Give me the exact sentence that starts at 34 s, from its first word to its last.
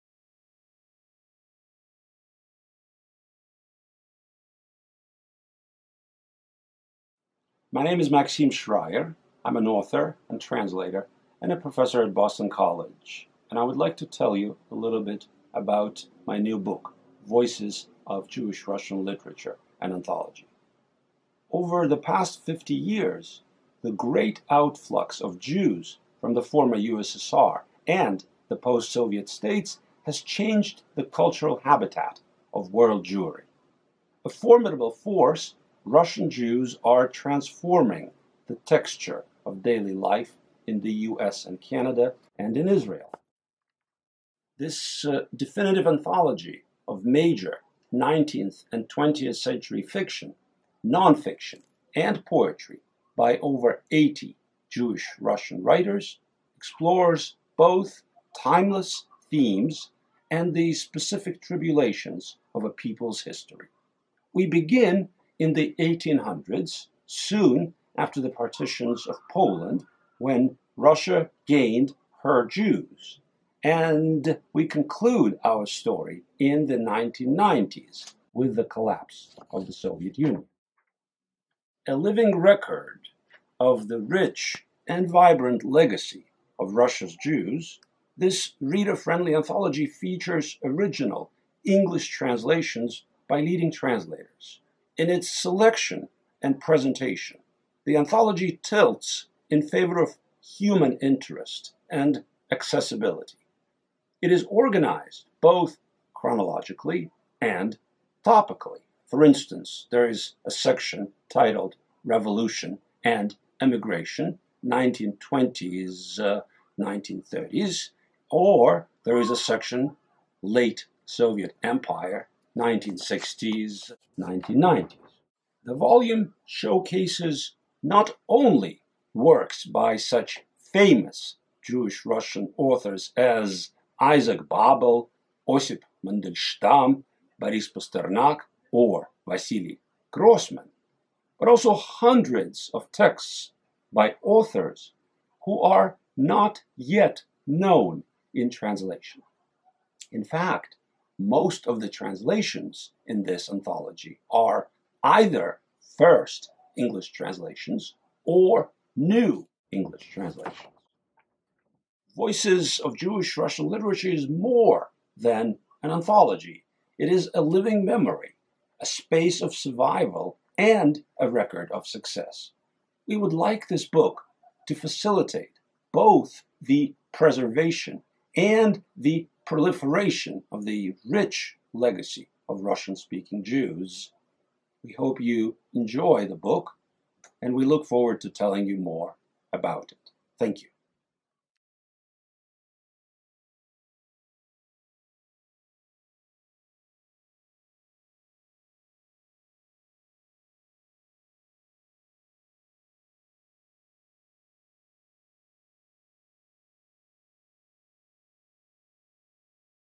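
A formidable force Russian Jews are transforming the texture of daily life in the US and Canada and in Israel.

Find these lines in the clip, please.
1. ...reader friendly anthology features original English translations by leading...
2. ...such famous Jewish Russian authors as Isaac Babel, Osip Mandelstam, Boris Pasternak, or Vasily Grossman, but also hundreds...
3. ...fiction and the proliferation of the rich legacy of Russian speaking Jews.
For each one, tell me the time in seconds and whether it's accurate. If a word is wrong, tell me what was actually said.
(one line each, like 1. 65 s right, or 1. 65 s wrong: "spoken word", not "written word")
1. 88 s right
2. 129 s right
3. 177 s wrong: "preservation", not "fiction".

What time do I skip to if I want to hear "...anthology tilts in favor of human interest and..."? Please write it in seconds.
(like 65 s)
97 s.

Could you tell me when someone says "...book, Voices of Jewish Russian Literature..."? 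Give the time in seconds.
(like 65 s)
16 s.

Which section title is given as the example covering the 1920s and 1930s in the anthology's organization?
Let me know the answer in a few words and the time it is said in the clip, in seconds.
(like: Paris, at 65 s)
Revolution and Emigration, at 112 s.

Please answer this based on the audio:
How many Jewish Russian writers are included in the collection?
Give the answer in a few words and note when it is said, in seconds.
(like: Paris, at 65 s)
over 80, at 53 s.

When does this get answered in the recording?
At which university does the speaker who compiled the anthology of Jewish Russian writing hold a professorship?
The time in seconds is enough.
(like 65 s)
12 s.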